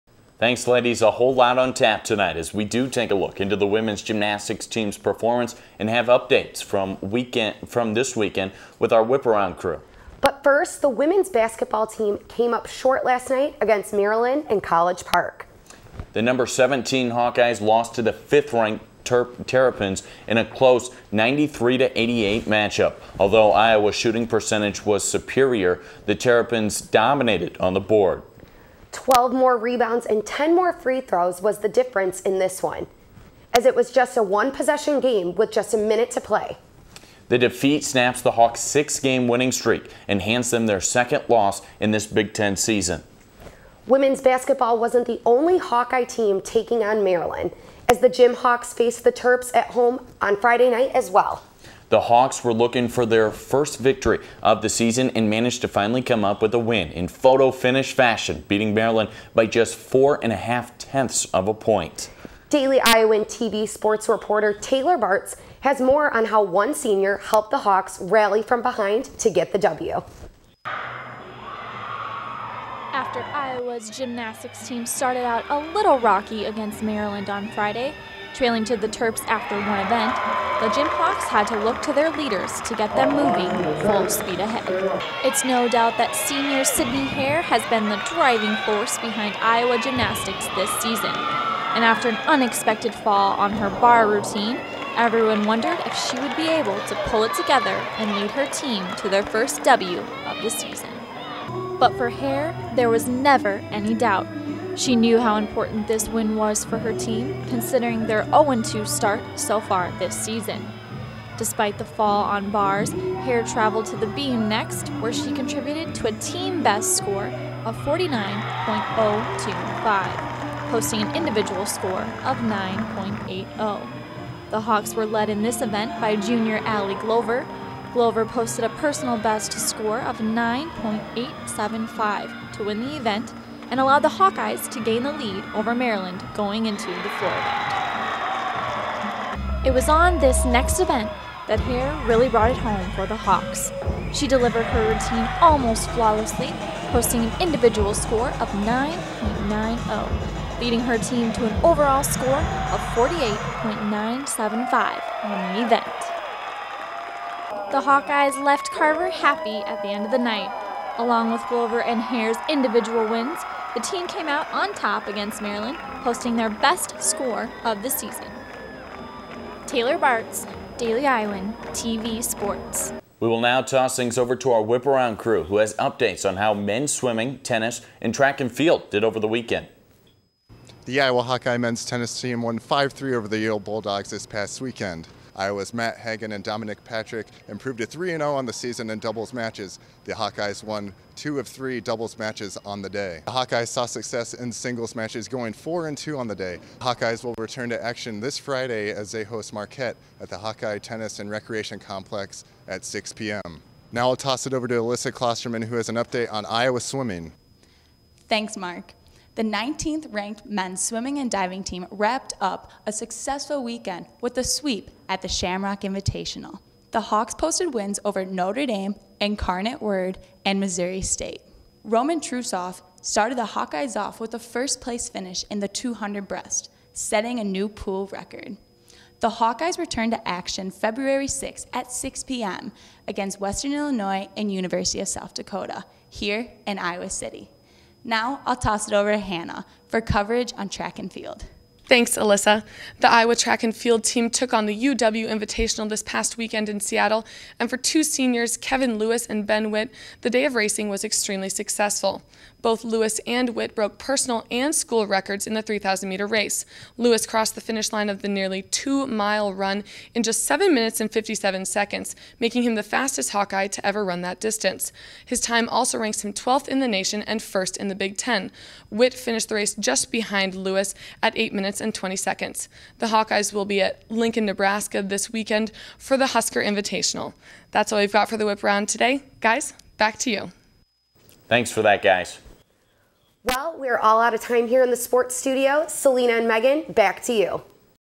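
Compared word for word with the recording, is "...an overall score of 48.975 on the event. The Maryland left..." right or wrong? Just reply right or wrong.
wrong.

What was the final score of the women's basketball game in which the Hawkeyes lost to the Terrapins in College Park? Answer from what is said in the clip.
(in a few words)
93-88.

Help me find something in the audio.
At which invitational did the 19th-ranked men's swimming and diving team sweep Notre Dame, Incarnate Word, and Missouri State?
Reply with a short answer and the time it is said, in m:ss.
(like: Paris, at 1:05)
Shamrock Invitational, at 3:35.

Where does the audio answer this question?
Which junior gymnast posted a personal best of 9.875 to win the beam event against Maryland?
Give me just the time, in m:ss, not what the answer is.
2:06.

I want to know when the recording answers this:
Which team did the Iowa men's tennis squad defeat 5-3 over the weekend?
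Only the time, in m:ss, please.
3:03.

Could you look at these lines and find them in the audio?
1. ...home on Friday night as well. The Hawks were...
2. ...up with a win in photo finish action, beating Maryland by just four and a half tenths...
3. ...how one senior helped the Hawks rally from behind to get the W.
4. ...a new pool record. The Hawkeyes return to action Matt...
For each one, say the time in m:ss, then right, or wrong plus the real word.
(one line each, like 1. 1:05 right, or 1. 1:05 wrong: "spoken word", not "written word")
1. 0:49 right
2. 0:56 wrong: "fashion", not "action"
3. 1:06 right
4. 3:47 wrong: "February", not "Matt".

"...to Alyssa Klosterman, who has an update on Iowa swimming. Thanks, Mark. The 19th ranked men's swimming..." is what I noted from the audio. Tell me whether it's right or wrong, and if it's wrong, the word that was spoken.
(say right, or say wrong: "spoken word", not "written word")
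right.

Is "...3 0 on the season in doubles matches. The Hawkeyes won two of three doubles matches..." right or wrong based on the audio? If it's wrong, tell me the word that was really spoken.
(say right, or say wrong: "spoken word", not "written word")
right.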